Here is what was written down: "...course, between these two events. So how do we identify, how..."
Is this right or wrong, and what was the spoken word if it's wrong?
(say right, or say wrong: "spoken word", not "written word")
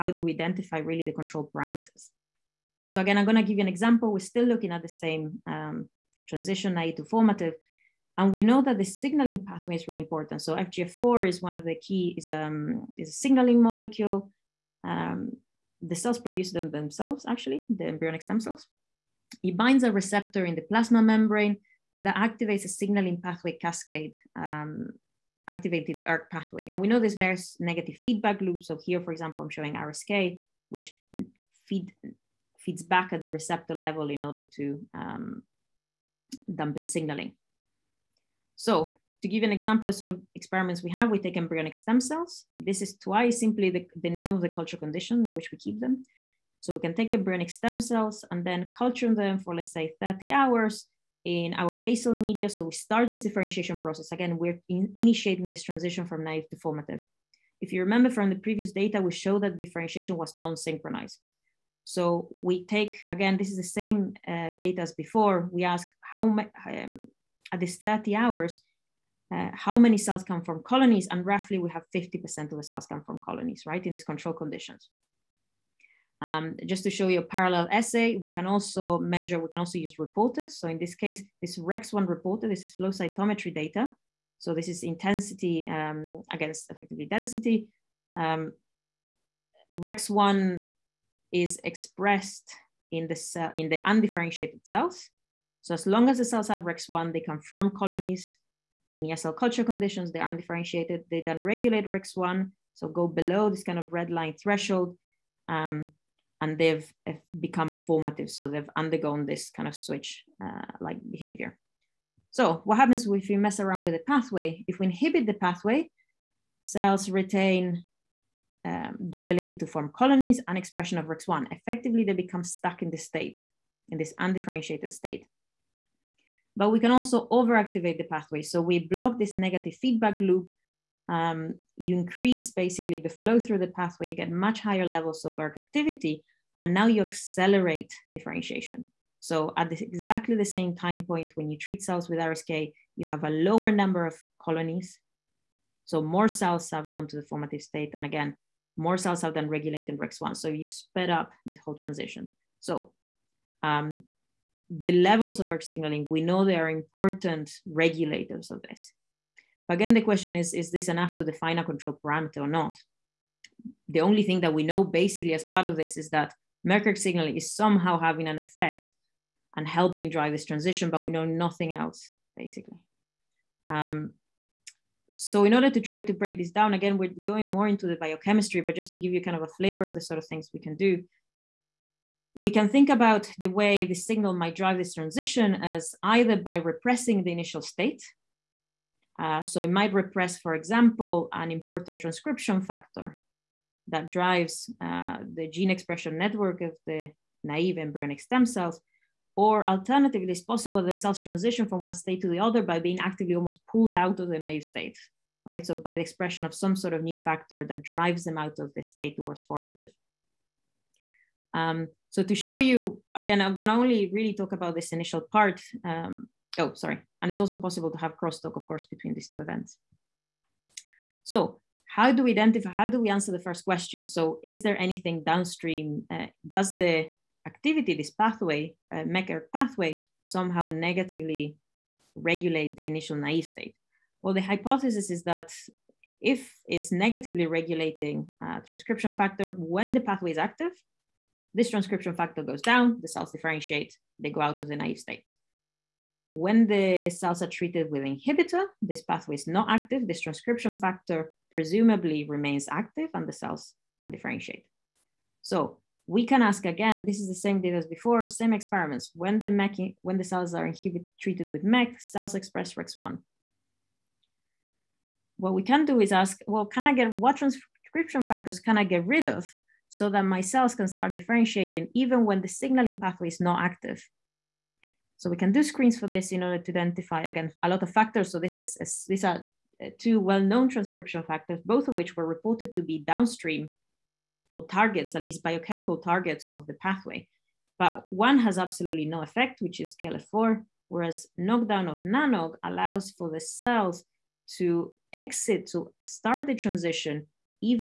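right.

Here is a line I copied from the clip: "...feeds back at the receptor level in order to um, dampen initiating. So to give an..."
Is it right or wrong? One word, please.
wrong.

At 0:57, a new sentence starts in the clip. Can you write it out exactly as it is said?
If you remember from the previous data, we showed that differentiation was non-synchronized.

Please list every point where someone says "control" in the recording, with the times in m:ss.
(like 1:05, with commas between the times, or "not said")
0:01, 1:14, 2:41.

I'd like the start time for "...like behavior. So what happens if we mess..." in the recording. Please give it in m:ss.
1:50.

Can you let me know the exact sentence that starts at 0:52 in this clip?
So we start this differentiation process.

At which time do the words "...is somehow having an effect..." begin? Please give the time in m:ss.
2:47.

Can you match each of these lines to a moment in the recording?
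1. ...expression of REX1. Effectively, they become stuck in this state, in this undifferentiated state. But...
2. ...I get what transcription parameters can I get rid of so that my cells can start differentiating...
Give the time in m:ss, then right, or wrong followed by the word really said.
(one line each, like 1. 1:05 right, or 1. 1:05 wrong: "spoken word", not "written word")
1. 2:00 right
2. 4:26 wrong: "factors", not "parameters".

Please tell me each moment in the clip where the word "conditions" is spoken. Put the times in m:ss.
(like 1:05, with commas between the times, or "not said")
0:44, 1:14, 1:39.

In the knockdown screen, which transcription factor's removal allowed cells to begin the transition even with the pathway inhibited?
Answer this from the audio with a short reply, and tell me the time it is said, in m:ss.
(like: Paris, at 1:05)
NANOG, at 4:52.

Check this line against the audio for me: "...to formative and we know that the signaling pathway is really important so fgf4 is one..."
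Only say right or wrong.
right.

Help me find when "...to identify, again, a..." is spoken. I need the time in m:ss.
4:36.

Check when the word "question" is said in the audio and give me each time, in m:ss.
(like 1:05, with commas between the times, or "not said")
2:40, 3:43.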